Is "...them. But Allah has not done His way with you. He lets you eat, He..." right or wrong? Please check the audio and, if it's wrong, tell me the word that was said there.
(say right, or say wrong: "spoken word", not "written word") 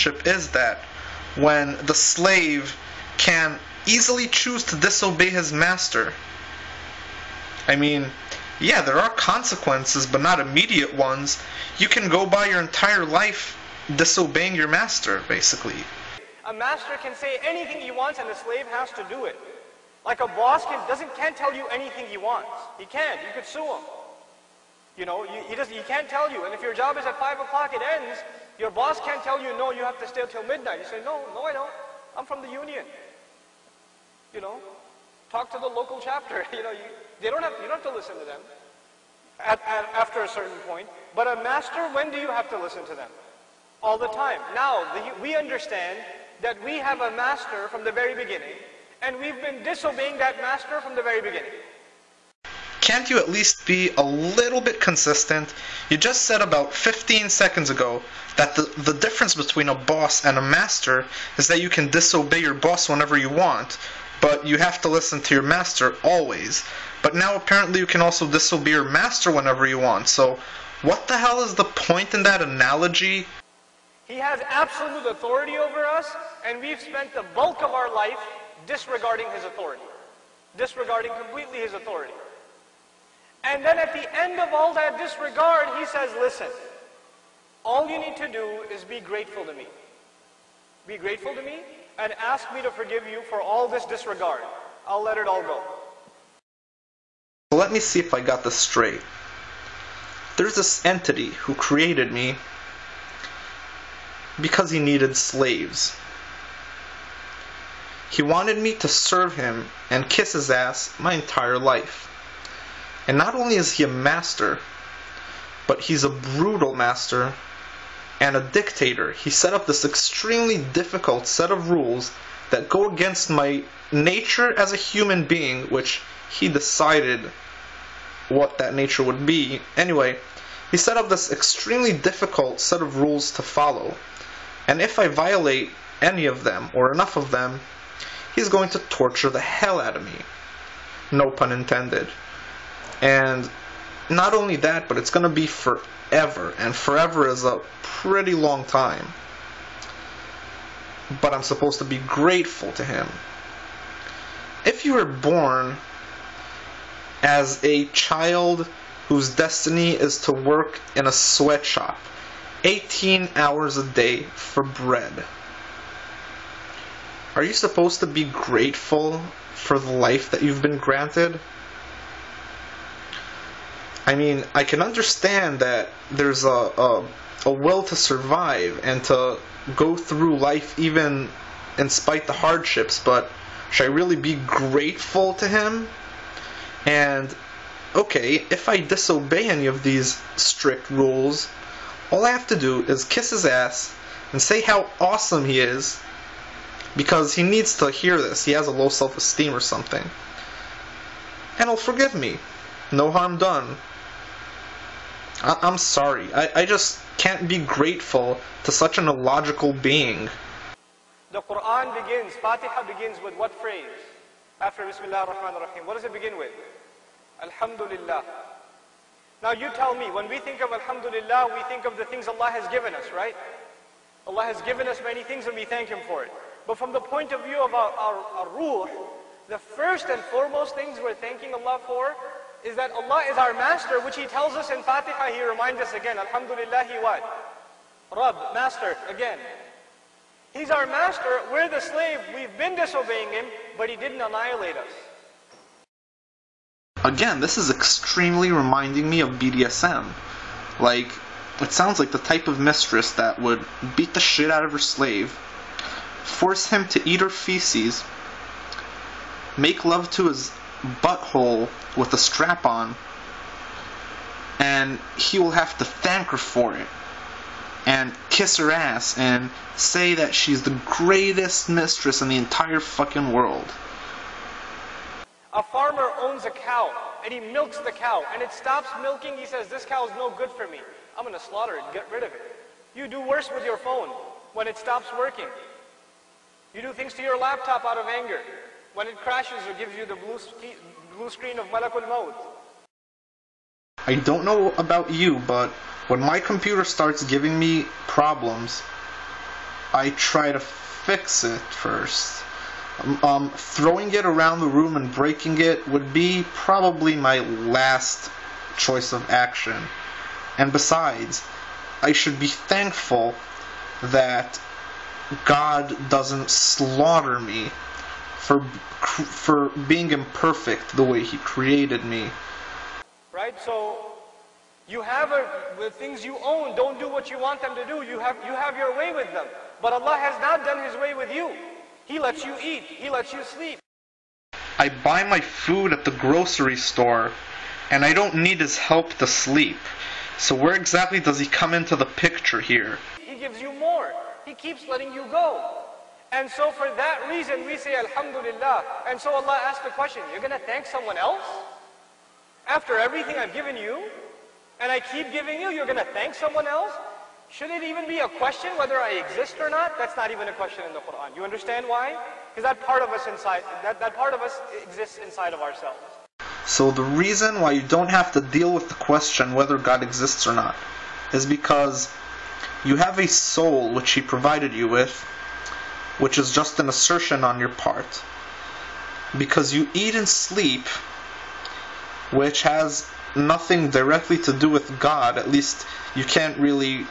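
right.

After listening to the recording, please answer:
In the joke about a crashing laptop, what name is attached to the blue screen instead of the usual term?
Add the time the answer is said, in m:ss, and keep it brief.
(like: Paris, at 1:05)
Malakul Maut, at 4:51.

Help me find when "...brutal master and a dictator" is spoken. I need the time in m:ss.
1:56.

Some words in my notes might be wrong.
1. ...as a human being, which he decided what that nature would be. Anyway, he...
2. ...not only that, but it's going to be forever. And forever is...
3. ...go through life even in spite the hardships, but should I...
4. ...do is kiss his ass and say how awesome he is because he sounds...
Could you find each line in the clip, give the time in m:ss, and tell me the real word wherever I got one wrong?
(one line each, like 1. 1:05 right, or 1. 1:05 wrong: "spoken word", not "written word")
1. 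2:04 right
2. 2:24 right
3. 2:59 right
4. 3:12 wrong: "needs", not "sounds".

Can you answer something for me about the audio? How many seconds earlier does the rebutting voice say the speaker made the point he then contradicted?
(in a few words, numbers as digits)
15.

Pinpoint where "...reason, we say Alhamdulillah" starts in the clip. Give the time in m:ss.
5:47.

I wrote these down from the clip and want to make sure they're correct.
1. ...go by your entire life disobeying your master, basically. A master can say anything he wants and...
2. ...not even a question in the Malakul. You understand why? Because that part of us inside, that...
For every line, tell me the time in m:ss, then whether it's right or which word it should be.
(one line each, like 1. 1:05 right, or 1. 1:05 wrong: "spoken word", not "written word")
1. 0:12 right
2. 6:00 wrong: "Quran", not "Malakul".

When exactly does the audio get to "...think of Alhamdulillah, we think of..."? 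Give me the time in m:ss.
3:40.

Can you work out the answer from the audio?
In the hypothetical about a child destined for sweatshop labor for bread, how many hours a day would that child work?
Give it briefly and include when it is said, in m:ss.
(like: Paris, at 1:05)
18, at 2:42.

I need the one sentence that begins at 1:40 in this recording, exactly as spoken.
There's this entity who created me because he needed slaves.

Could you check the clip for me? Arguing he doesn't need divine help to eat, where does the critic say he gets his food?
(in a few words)
The grocery store.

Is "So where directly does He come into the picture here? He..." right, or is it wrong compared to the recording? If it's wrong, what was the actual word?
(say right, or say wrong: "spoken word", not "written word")
wrong: "exactly", not "directly".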